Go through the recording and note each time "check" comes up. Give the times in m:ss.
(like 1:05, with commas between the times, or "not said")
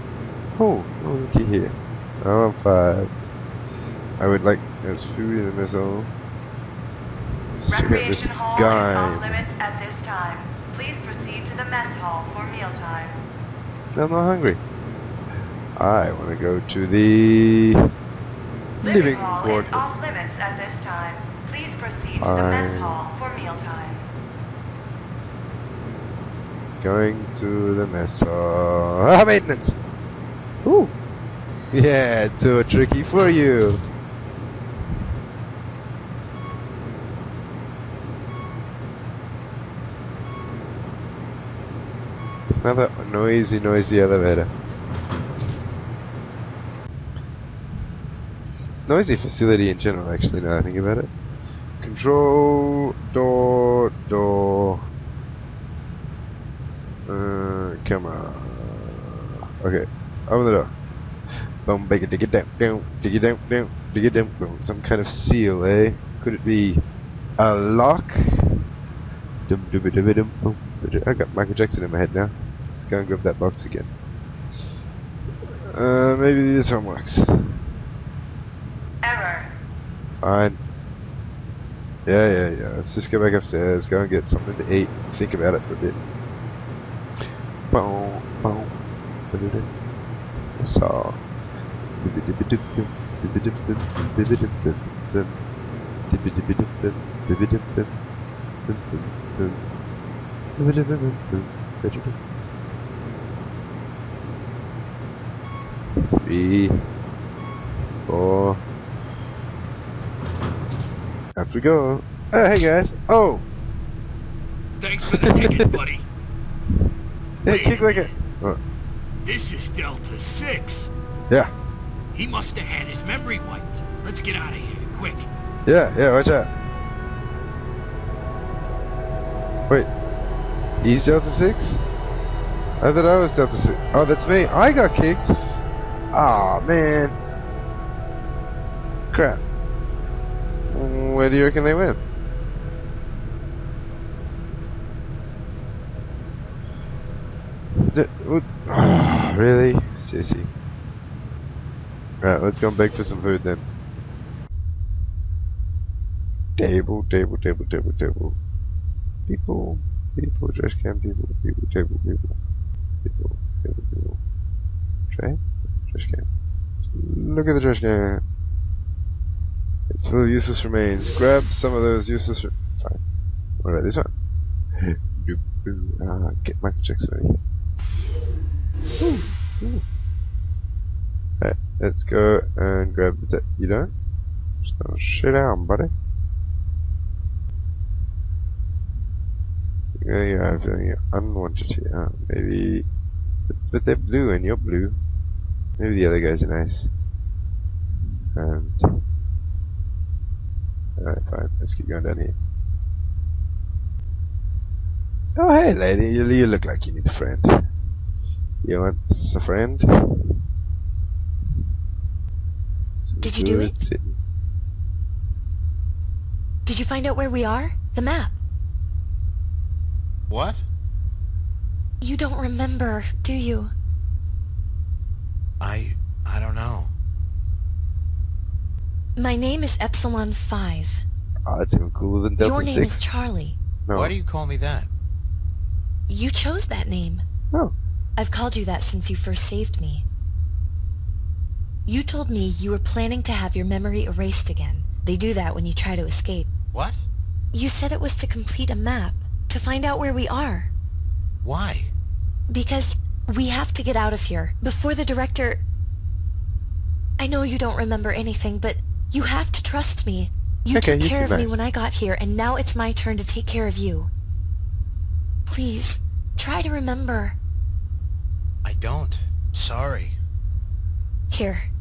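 0:07, 2:56.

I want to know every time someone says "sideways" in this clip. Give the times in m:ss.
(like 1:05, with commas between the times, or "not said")
not said.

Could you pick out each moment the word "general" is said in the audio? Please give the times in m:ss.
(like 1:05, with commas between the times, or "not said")
0:49.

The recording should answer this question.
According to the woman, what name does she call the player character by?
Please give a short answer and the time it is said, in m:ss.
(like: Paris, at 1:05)
Charlie, at 3:53.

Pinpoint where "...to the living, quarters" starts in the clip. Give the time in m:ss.
0:16.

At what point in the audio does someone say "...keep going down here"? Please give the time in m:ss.
3:21.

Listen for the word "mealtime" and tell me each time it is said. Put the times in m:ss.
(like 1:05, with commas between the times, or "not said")
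0:12, 0:23.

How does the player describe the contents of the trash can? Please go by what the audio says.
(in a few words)
Useless remains.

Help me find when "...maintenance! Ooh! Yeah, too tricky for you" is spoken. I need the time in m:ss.
0:29.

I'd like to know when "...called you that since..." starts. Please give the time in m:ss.
3:58.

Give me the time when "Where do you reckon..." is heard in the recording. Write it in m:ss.
2:21.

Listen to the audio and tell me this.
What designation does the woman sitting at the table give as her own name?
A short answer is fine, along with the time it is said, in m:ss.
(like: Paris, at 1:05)
Epsilon 5, at 3:49.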